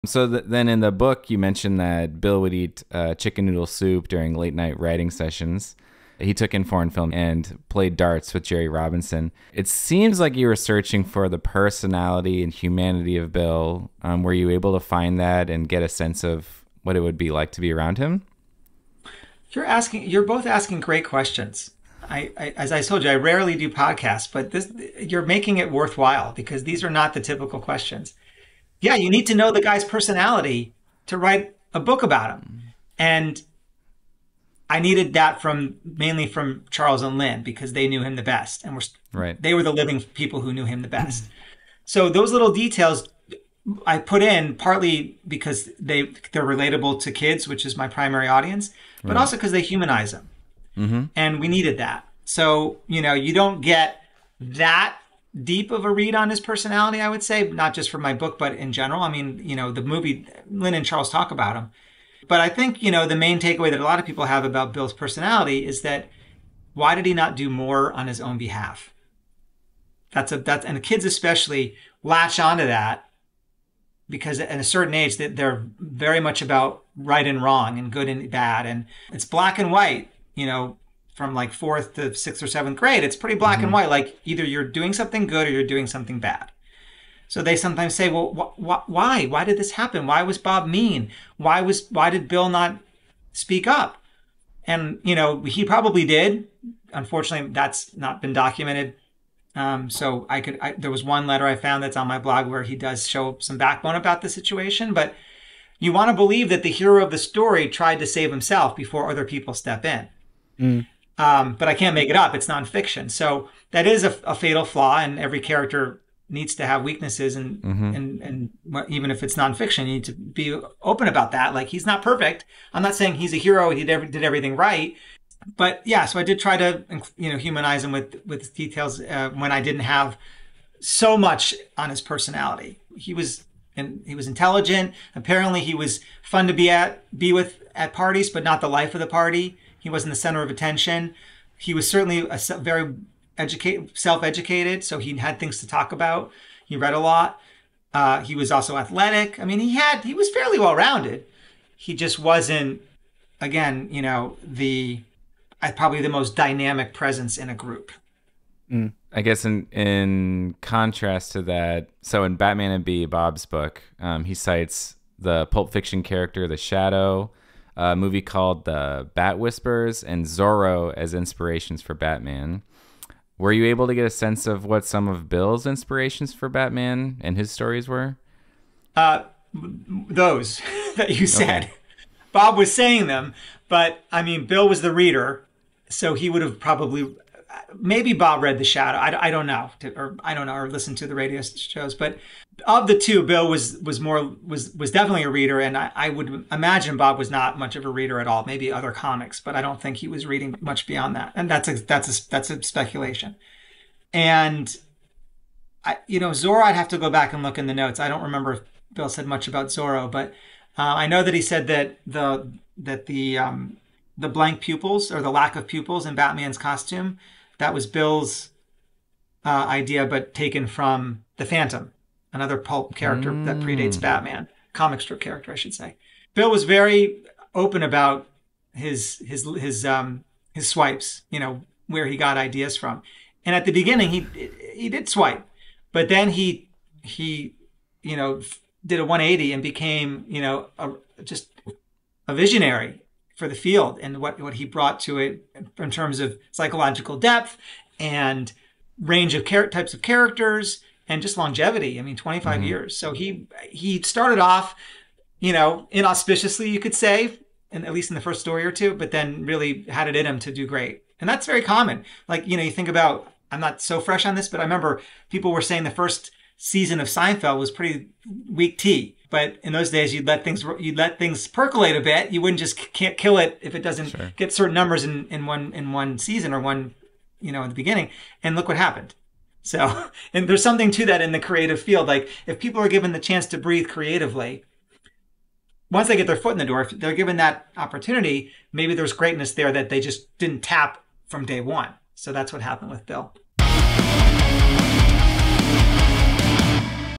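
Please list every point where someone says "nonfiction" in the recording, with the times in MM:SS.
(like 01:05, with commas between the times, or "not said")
01:52, 01:59.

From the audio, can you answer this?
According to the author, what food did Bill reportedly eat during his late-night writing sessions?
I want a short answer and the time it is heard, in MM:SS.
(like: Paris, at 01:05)
Chicken noodle soup, at 00:03.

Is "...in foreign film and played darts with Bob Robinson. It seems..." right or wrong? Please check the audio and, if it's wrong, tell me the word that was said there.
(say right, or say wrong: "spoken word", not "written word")
wrong: "Jerry", not "Bob".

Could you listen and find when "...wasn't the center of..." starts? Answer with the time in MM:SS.
02:19.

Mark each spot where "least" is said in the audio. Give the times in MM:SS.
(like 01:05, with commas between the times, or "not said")
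04:17.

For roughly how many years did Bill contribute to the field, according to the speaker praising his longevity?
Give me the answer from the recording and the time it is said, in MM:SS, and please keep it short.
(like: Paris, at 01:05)
25, at 04:12.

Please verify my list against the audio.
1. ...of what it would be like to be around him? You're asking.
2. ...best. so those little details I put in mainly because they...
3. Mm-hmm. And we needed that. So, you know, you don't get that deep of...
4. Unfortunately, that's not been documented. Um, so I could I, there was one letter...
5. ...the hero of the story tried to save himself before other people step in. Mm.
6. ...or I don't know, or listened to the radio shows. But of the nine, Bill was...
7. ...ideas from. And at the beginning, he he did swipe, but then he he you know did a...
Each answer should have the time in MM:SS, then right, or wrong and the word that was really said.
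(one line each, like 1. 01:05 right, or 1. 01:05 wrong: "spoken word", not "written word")
1. 00:16 right
2. 00:40 wrong: "partly", not "mainly"
3. 00:50 right
4. 01:36 right
5. 01:46 right
6. 03:09 wrong: "two", not "nine"
7. 03:52 right.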